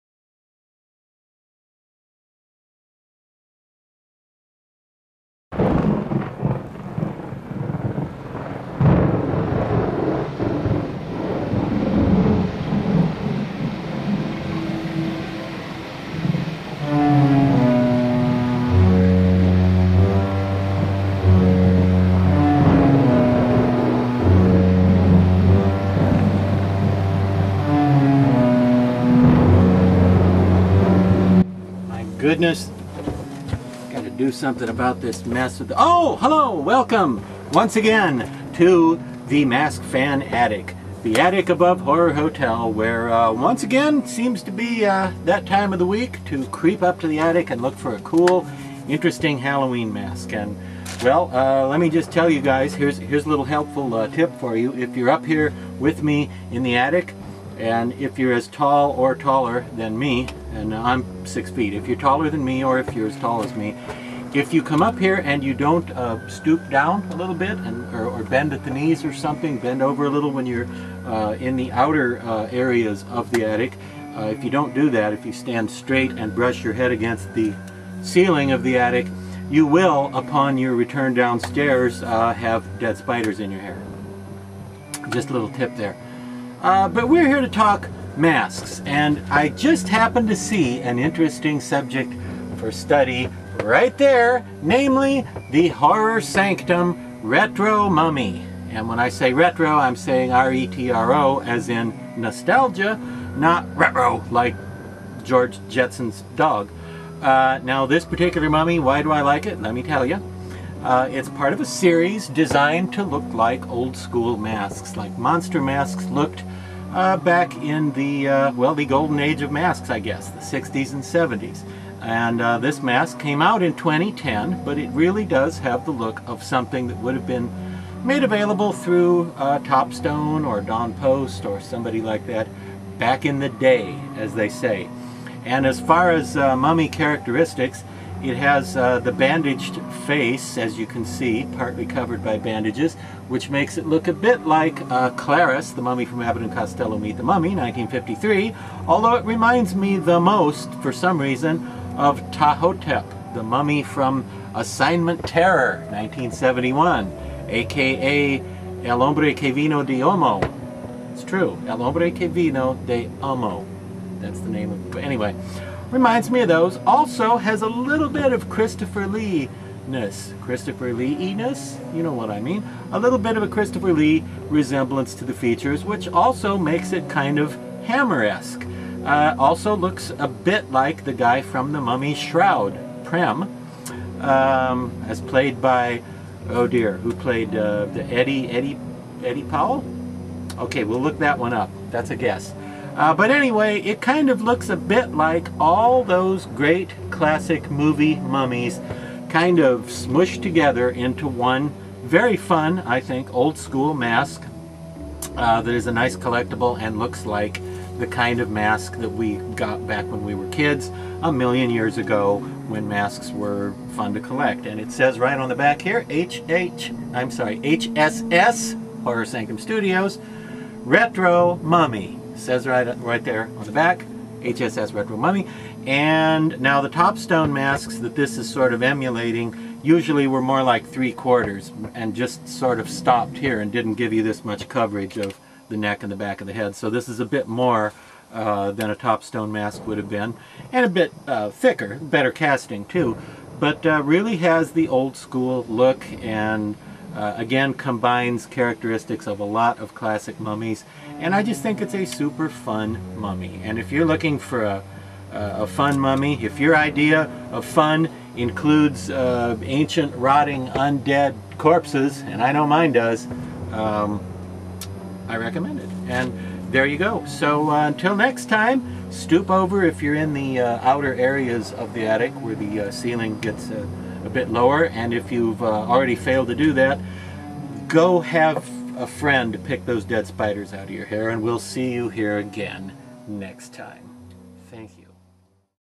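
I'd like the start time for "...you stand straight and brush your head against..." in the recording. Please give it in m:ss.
1:15.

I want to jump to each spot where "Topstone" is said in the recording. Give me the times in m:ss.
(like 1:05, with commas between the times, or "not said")
2:09, 3:46, 3:58.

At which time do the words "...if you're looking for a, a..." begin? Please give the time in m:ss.
4:13.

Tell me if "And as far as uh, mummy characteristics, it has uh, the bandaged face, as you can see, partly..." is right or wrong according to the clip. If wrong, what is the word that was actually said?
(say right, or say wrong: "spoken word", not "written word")
right.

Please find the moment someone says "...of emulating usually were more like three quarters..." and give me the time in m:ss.
3:48.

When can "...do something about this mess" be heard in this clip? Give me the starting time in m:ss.
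0:34.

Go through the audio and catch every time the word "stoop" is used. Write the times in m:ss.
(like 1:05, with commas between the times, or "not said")
1:06, 4:29.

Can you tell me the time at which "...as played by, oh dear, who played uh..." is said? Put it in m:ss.
3:05.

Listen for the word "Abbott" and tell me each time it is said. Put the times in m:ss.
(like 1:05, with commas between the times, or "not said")
2:26.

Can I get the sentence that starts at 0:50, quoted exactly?
And well, uh, let me just tell you guys, here's, here's a little helpful uh, tip for you.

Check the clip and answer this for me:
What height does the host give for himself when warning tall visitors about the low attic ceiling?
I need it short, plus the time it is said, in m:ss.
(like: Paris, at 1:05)
6 feet, at 1:01.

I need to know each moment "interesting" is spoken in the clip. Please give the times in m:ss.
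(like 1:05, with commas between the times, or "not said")
0:48, 1:30.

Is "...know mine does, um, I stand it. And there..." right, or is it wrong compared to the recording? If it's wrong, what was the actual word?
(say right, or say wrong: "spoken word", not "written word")
wrong: "recommend", not "stand".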